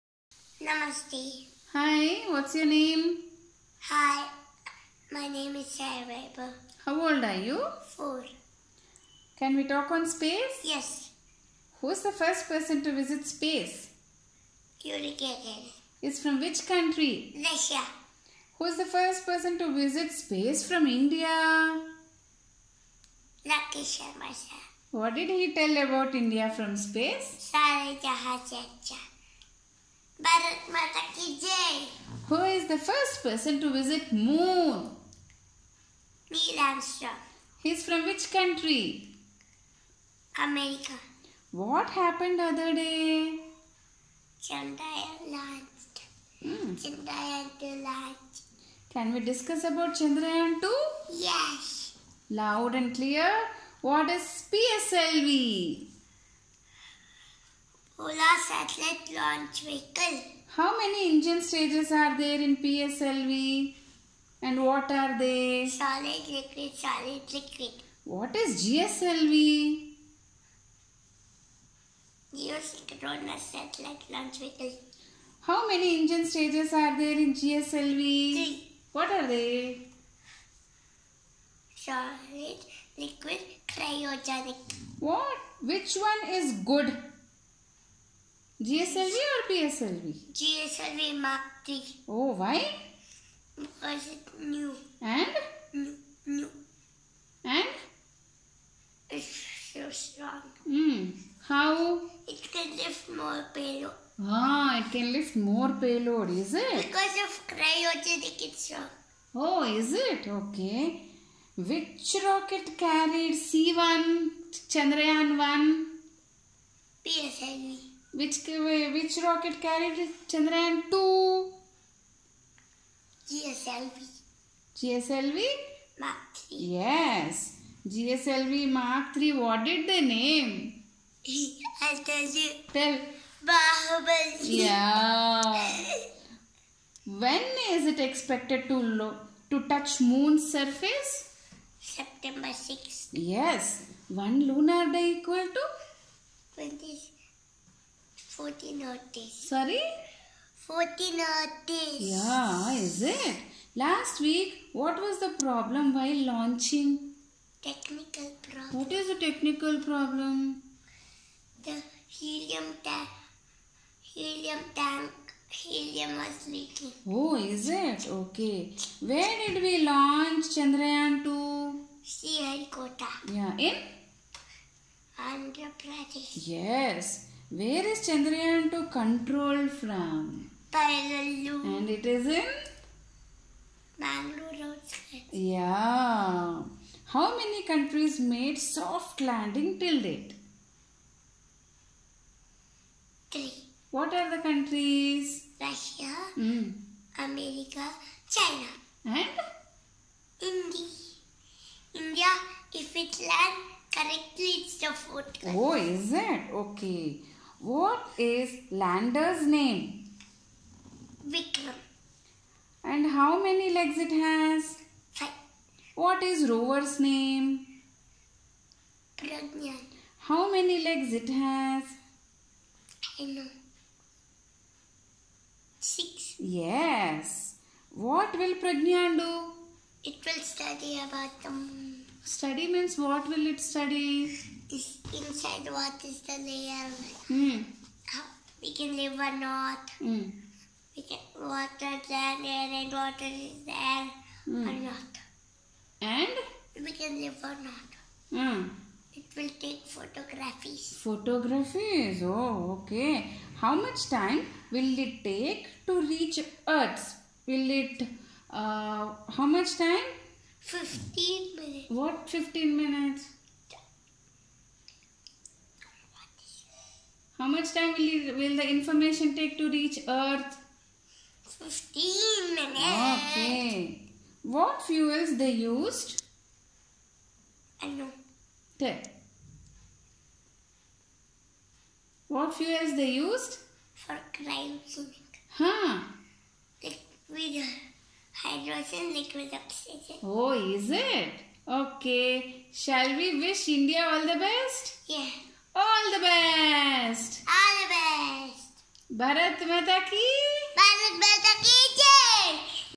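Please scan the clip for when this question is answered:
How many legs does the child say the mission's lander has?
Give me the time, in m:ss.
3:35.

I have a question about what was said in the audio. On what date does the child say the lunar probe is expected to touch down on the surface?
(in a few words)
September 6.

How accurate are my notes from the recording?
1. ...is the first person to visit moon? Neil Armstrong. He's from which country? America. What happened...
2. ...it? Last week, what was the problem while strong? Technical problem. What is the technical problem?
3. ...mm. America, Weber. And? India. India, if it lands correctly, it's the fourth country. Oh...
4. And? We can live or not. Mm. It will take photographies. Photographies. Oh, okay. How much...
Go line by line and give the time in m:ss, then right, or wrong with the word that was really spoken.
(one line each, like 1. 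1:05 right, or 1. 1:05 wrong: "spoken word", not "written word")
1. 0:32 right
2. 2:33 wrong: "launching", not "strong"
3. 3:16 wrong: "China", not "Weber"
4. 4:06 right.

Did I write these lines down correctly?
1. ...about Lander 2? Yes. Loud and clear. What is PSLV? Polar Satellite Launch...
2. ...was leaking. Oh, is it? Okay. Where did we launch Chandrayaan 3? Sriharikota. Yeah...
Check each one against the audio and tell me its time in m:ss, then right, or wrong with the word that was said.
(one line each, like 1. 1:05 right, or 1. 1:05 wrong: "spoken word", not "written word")
1. 0:49 wrong: "Chandrayaan", not "Lander"
2. 2:46 wrong: "2", not "3".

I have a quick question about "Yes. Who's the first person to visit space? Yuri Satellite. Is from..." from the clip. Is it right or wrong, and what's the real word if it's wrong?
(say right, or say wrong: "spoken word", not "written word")
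wrong: "Gagarin", not "Satellite".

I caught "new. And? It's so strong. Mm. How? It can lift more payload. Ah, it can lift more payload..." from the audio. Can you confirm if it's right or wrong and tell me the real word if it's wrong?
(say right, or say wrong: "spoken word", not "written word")
right.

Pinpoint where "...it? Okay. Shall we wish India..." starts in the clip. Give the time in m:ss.
4:50.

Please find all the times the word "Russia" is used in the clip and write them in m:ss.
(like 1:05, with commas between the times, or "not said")
0:17, 3:15.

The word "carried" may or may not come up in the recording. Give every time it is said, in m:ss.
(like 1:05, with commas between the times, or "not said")
1:52, 1:59.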